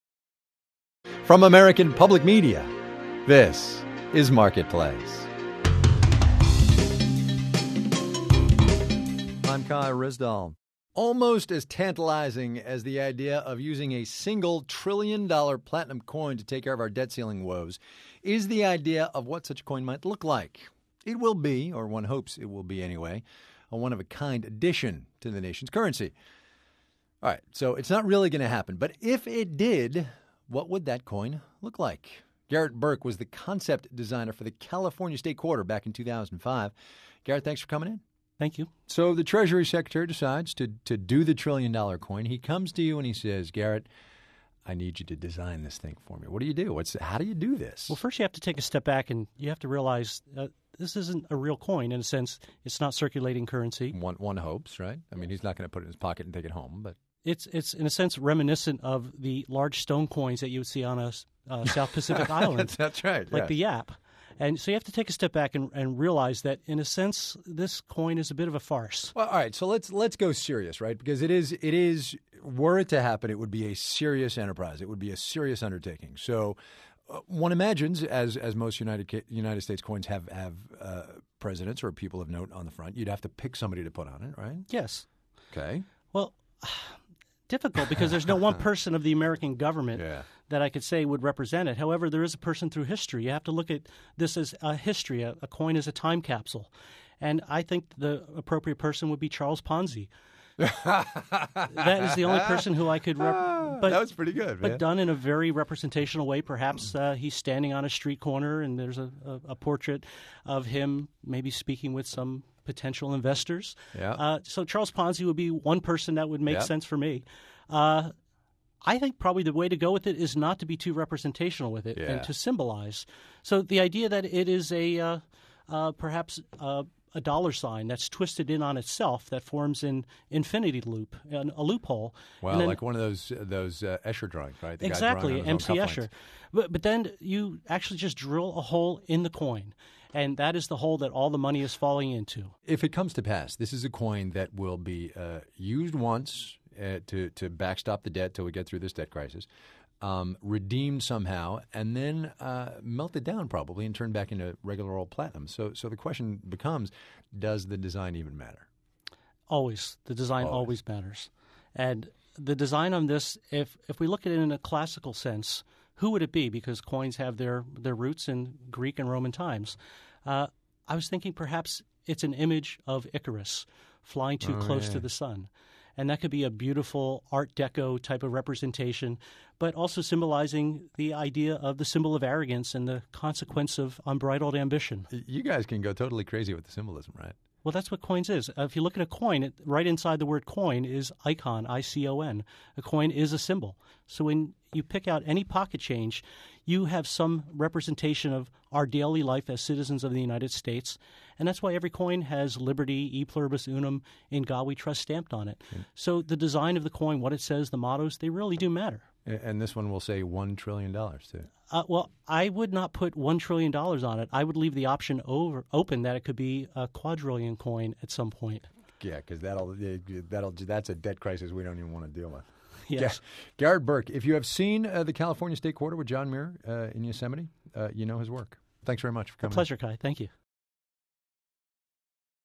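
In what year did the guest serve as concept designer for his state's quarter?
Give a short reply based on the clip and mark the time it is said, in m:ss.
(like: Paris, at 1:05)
2005, at 0:35.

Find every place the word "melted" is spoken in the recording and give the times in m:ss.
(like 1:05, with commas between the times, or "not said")
2:32.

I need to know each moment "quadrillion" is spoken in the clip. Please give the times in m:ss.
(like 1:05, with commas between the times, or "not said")
3:36.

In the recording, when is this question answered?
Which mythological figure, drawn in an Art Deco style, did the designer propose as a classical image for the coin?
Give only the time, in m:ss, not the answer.
2:53.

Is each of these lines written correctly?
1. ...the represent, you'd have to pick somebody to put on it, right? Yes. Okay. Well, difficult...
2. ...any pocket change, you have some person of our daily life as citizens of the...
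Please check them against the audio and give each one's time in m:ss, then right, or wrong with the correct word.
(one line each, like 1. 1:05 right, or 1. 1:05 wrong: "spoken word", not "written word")
1. 1:22 wrong: "front", not "represent"
2. 3:15 wrong: "representation", not "person".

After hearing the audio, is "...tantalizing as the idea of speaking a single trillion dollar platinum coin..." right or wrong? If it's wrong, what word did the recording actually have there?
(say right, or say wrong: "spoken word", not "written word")
wrong: "using", not "speaking".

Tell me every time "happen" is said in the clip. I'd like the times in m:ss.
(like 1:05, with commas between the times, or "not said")
0:28, 1:13.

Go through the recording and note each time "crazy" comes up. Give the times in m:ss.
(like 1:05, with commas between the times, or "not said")
3:06.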